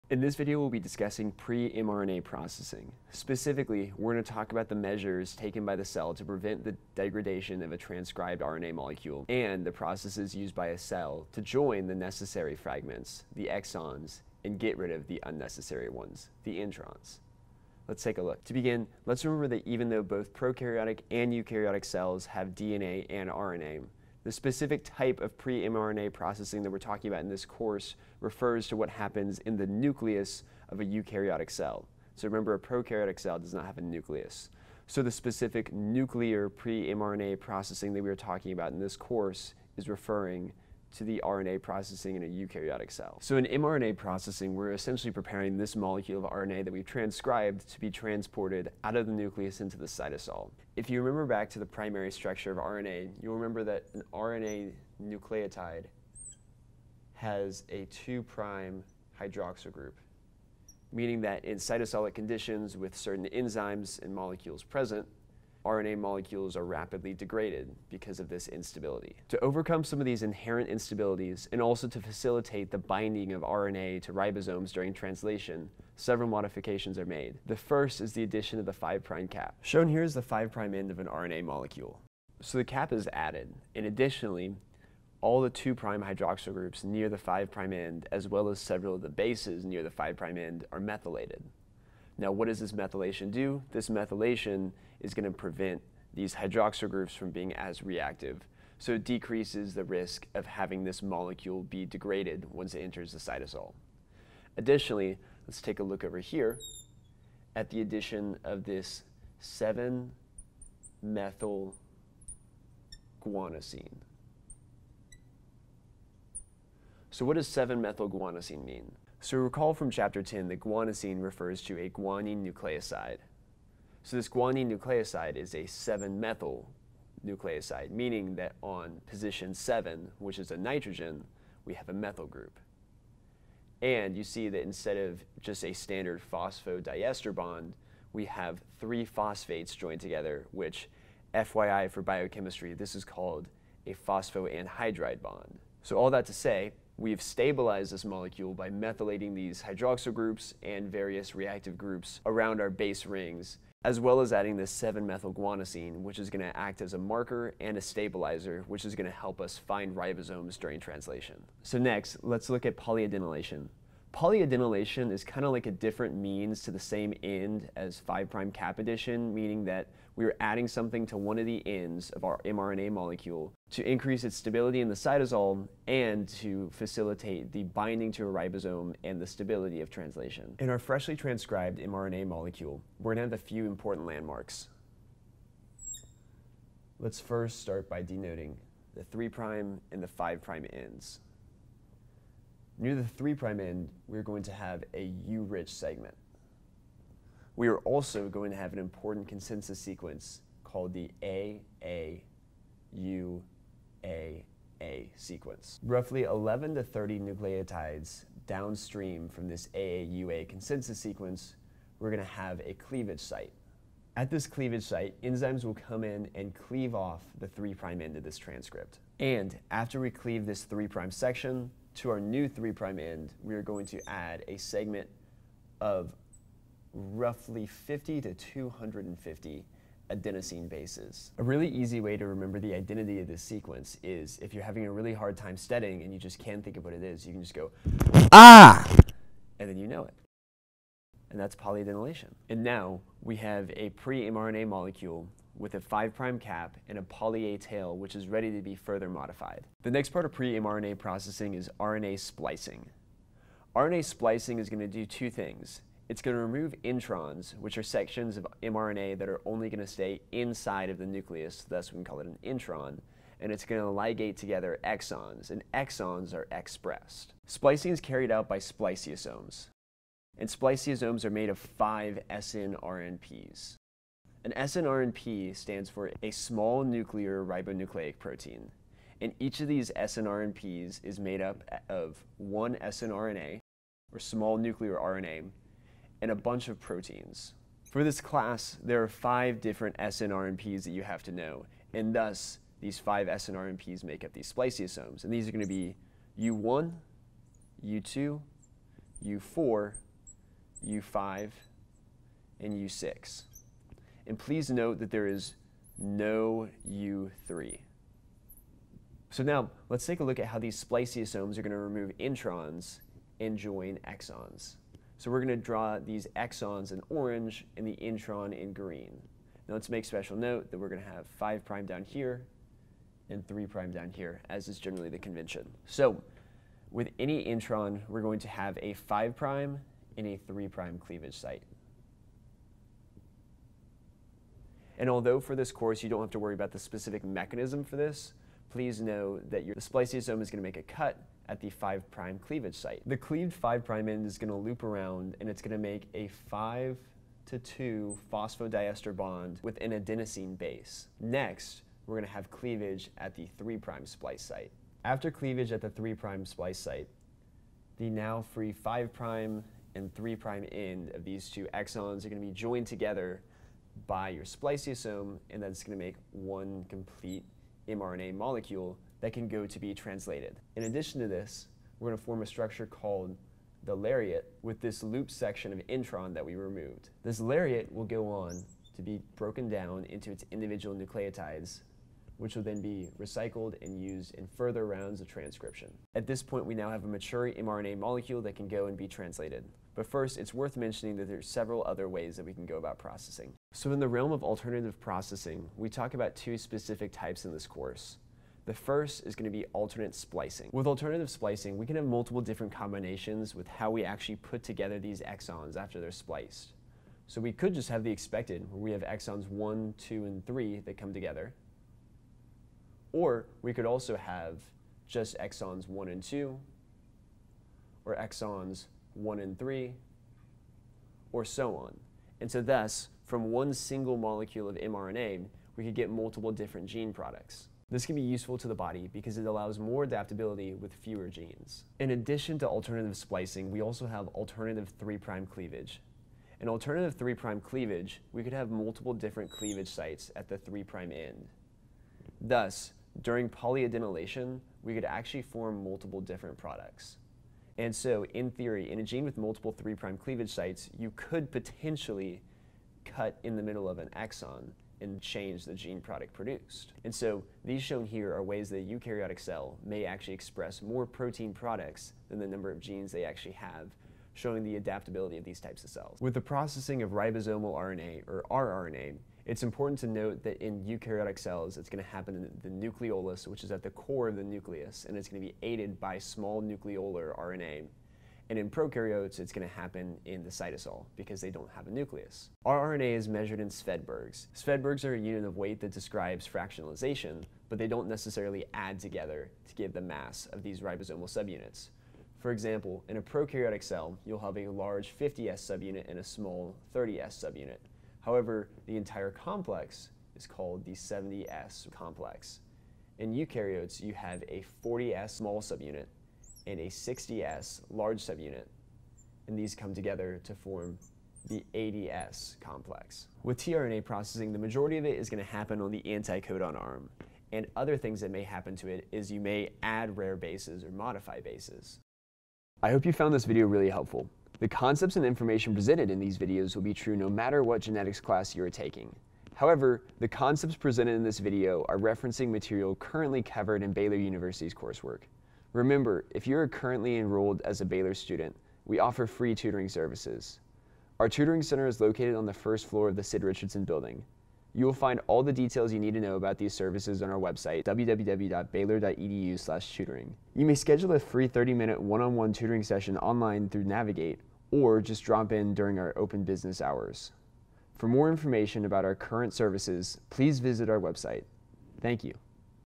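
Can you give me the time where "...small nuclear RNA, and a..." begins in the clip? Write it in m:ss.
4:44.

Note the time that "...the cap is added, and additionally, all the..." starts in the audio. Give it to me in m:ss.
1:22.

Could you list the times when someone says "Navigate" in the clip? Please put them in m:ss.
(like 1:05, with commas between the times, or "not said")
9:13.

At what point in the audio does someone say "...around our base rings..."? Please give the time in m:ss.
2:32.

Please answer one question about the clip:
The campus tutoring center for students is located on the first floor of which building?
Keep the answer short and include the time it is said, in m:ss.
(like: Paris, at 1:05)
Sid Richardson building, at 9:03.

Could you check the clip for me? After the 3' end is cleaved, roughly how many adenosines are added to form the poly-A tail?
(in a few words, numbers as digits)
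50 to 250.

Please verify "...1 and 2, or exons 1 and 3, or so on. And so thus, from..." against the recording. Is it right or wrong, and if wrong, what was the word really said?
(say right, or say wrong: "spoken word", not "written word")
right.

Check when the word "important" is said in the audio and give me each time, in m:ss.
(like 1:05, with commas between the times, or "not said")
3:03, 3:18, 7:49.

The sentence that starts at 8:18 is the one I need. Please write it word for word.
However, the entire complex is called the 70S complex.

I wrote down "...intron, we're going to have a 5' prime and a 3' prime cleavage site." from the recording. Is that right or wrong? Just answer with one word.
right.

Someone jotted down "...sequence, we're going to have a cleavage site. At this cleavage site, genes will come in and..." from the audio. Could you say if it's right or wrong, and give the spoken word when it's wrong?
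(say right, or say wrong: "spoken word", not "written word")
wrong: "enzymes", not "genes".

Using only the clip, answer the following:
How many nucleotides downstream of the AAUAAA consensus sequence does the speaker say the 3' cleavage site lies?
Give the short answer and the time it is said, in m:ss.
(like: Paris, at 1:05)
11 to 30, at 3:26.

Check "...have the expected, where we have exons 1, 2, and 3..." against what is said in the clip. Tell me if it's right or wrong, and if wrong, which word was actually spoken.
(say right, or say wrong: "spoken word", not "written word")
right.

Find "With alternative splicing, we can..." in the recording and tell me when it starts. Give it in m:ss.
6:40.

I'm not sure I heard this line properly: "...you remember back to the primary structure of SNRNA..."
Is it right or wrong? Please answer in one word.
wrong.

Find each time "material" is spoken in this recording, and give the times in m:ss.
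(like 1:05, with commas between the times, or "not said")
8:52.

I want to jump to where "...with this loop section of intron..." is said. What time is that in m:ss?
6:14.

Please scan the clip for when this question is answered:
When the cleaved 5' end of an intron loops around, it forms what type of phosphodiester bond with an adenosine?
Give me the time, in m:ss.
5:46.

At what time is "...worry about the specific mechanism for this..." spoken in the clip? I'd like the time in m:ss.
5:36.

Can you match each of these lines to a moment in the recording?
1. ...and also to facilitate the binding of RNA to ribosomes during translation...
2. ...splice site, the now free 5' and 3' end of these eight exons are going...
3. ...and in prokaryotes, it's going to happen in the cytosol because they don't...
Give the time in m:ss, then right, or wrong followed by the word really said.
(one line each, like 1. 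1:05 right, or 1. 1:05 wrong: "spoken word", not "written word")
1. 1:11 right
2. 5:56 wrong: "two", not "eight"
3. 7:58 right.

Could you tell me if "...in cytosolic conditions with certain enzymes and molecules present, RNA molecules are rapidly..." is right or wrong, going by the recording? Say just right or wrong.
right.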